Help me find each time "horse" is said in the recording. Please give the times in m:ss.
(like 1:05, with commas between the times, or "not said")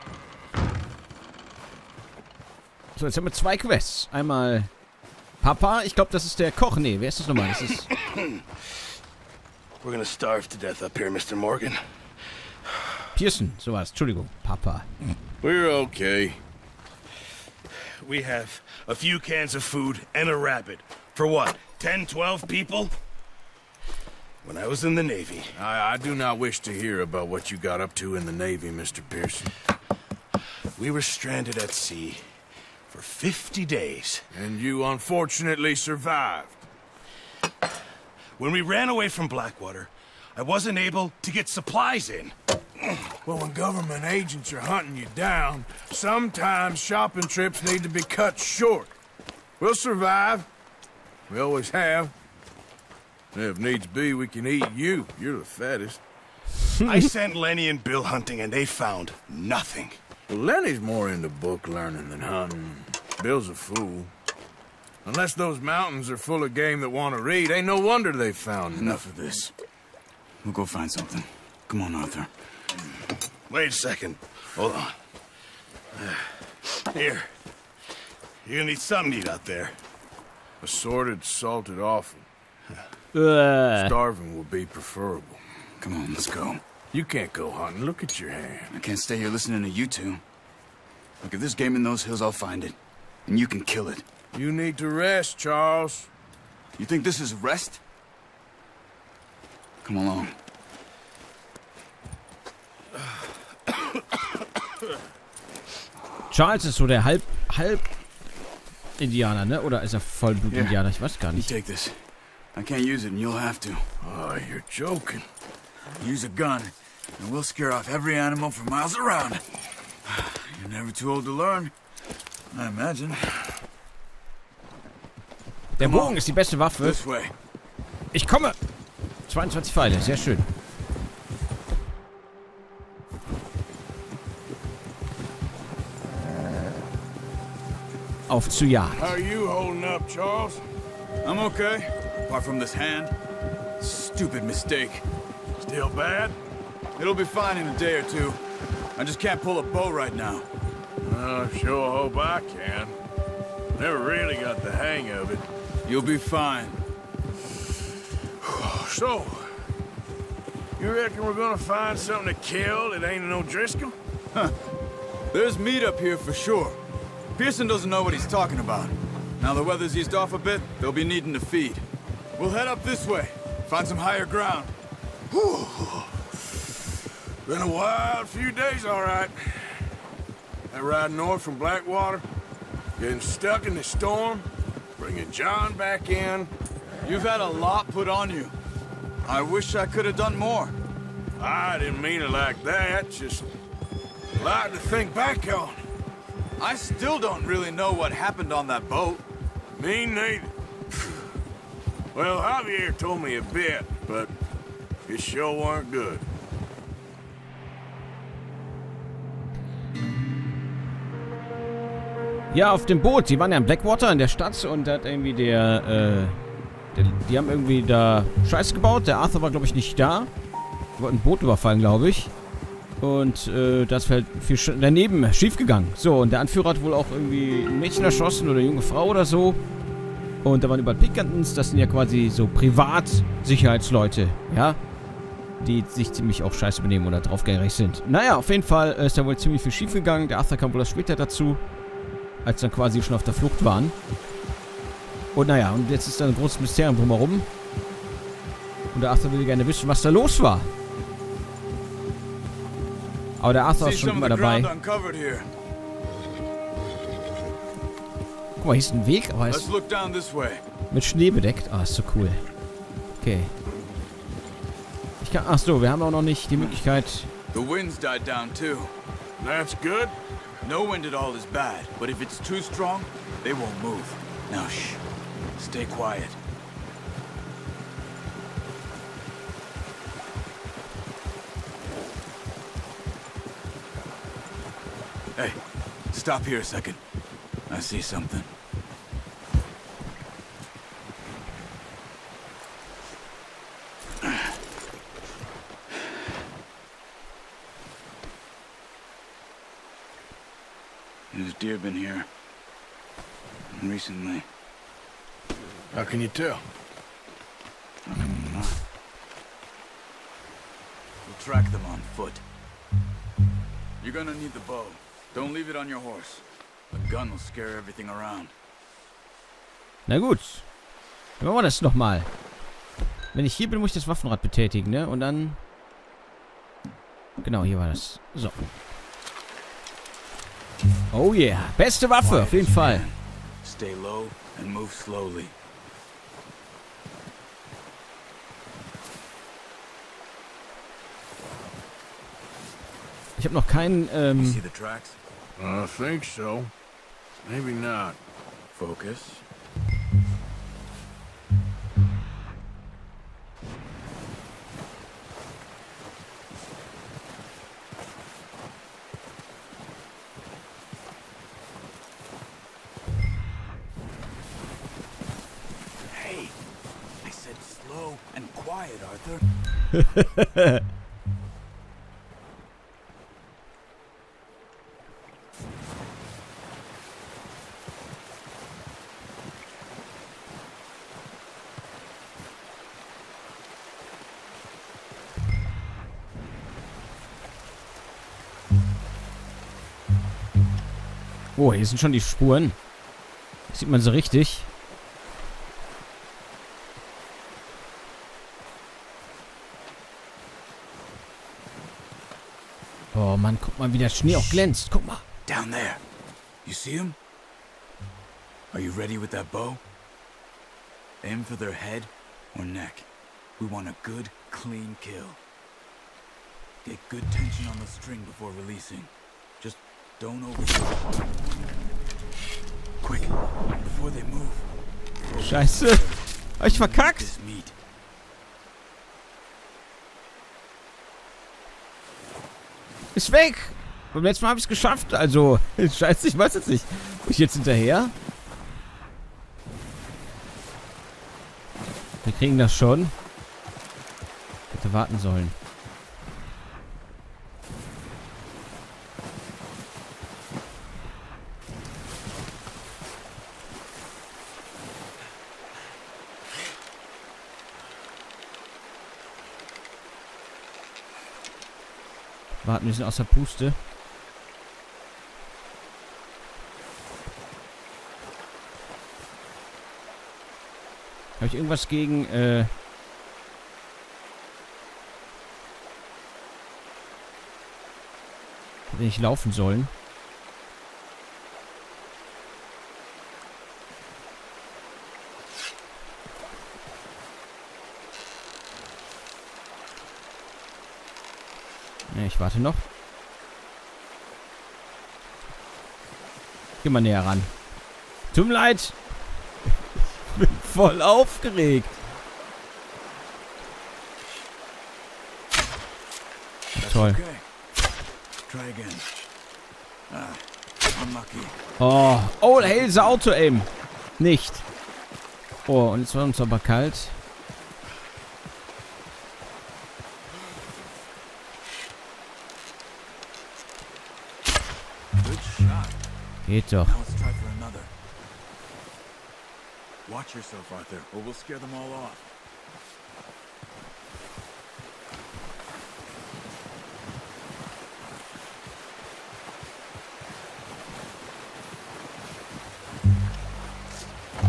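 5:15.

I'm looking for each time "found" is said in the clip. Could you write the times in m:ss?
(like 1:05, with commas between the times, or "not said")
0:58, 1:08.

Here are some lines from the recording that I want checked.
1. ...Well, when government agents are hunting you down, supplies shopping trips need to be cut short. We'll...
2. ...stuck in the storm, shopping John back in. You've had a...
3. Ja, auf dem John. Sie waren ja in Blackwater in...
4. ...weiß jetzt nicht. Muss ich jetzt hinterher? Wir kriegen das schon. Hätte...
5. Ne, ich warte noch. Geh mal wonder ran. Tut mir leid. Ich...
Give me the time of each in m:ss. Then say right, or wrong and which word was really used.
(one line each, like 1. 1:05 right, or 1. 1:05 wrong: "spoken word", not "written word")
1. 0:43 wrong: "sometimes", not "supplies"
2. 3:03 wrong: "bringing", not "shopping"
3. 3:32 wrong: "Boot", not "John"
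4. 7:16 right
5. 8:12 wrong: "näher", not "wonder".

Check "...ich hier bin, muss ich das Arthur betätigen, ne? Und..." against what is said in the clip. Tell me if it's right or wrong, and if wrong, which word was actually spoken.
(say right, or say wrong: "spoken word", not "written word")
wrong: "Waffenrad", not "Arthur".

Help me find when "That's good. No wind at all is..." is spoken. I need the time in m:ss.
4:29.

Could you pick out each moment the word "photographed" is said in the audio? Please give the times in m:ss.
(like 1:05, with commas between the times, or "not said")
not said.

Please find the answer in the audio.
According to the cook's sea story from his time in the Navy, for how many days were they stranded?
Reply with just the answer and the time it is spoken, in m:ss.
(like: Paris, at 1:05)
50, at 0:33.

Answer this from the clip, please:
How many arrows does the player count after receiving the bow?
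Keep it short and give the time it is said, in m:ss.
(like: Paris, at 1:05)
22, at 2:09.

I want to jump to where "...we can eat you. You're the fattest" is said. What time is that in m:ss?
0:54.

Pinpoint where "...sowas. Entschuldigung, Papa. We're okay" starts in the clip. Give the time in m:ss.
0:13.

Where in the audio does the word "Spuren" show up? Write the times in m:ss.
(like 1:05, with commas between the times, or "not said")
6:32.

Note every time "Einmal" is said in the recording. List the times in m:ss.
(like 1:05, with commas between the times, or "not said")
0:04.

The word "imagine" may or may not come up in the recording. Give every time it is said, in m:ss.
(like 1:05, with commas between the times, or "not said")
2:02.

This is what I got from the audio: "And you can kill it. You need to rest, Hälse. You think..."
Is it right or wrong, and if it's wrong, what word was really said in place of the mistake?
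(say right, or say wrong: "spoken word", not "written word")
wrong: "Charles", not "Hälse".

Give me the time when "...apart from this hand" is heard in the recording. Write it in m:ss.
2:22.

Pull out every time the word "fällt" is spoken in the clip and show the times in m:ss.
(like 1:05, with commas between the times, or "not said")
3:44.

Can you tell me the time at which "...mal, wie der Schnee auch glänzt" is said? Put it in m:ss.
6:43.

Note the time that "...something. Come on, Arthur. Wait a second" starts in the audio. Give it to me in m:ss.
1:10.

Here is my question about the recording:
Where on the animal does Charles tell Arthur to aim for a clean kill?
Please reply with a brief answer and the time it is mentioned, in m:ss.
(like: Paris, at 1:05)
Head or neck, at 6:51.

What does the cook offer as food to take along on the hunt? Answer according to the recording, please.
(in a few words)
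Assorted, salted awful.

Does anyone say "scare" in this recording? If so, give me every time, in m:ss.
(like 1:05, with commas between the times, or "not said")
1:57, 5:17, 8:51.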